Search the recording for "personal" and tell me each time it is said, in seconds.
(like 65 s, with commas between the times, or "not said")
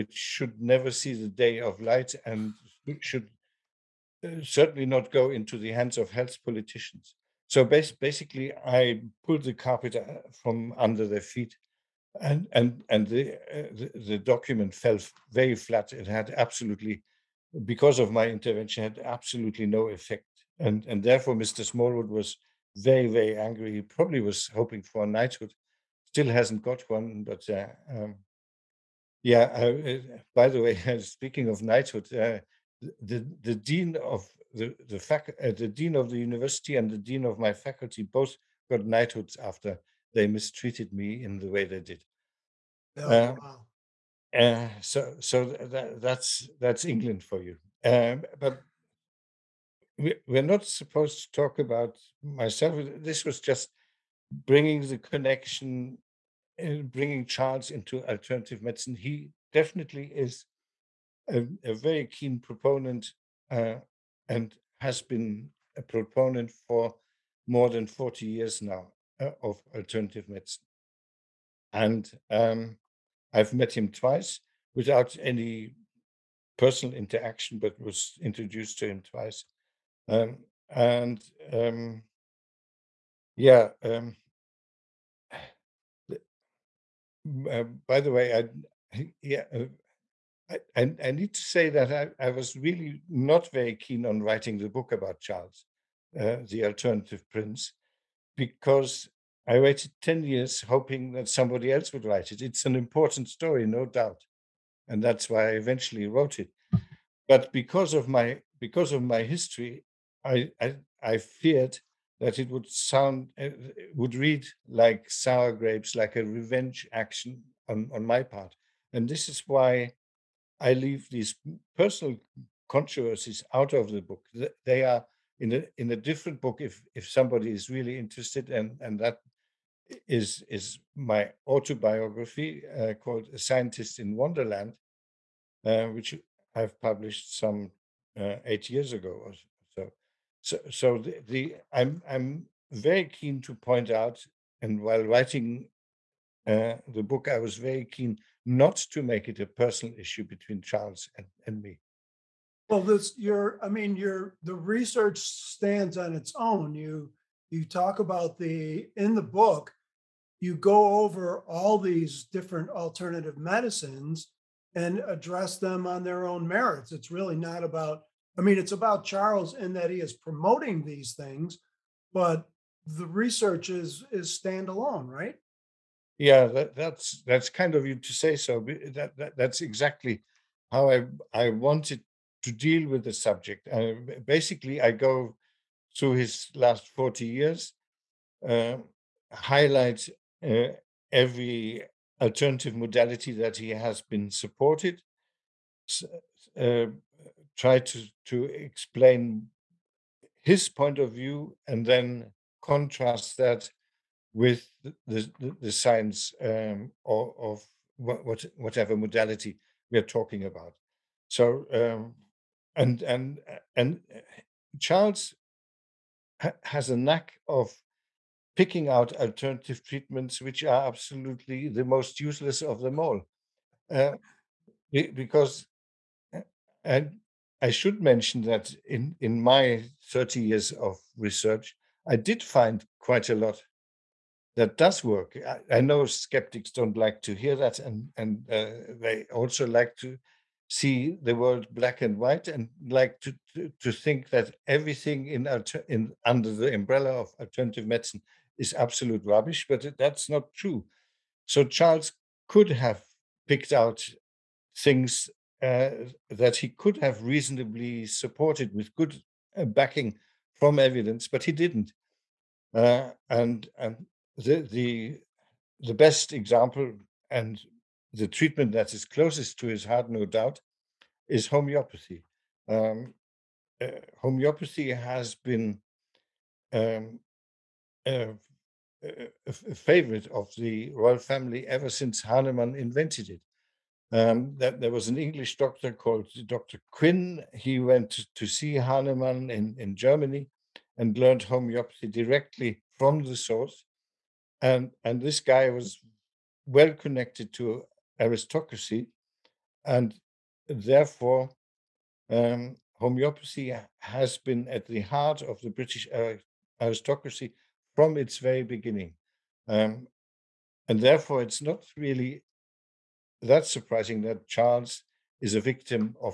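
76 s, 121 s, 149 s.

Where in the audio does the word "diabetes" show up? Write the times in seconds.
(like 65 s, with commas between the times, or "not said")
not said.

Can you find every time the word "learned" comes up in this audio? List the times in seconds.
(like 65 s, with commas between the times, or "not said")
291 s.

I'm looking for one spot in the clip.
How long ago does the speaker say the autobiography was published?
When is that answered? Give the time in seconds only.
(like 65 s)
138 s.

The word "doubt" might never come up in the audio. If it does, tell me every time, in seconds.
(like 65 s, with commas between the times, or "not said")
103 s, 270 s.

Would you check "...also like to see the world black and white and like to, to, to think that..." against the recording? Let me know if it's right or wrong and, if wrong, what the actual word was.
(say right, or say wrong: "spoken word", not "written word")
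right.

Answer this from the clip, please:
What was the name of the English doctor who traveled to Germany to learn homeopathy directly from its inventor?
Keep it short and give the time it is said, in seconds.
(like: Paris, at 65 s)
Dr. Quin, at 286 s.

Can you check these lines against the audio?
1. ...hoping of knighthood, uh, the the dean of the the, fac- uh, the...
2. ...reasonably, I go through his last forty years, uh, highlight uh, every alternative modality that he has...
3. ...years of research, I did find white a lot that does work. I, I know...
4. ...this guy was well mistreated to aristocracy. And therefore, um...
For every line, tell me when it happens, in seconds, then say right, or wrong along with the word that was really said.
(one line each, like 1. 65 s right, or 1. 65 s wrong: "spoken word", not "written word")
1. 31 s wrong: "speaking", not "hoping"
2. 184 s wrong: "basically", not "reasonably"
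3. 230 s wrong: "quite", not "white"
4. 295 s wrong: "connected", not "mistreated".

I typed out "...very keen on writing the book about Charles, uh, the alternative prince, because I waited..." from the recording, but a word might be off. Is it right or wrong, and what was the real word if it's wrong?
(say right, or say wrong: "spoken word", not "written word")
right.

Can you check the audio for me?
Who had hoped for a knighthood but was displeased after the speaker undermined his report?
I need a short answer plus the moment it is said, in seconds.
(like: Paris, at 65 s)
Mr. Smallwood, at 21 s.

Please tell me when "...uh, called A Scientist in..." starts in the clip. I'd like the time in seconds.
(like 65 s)
132 s.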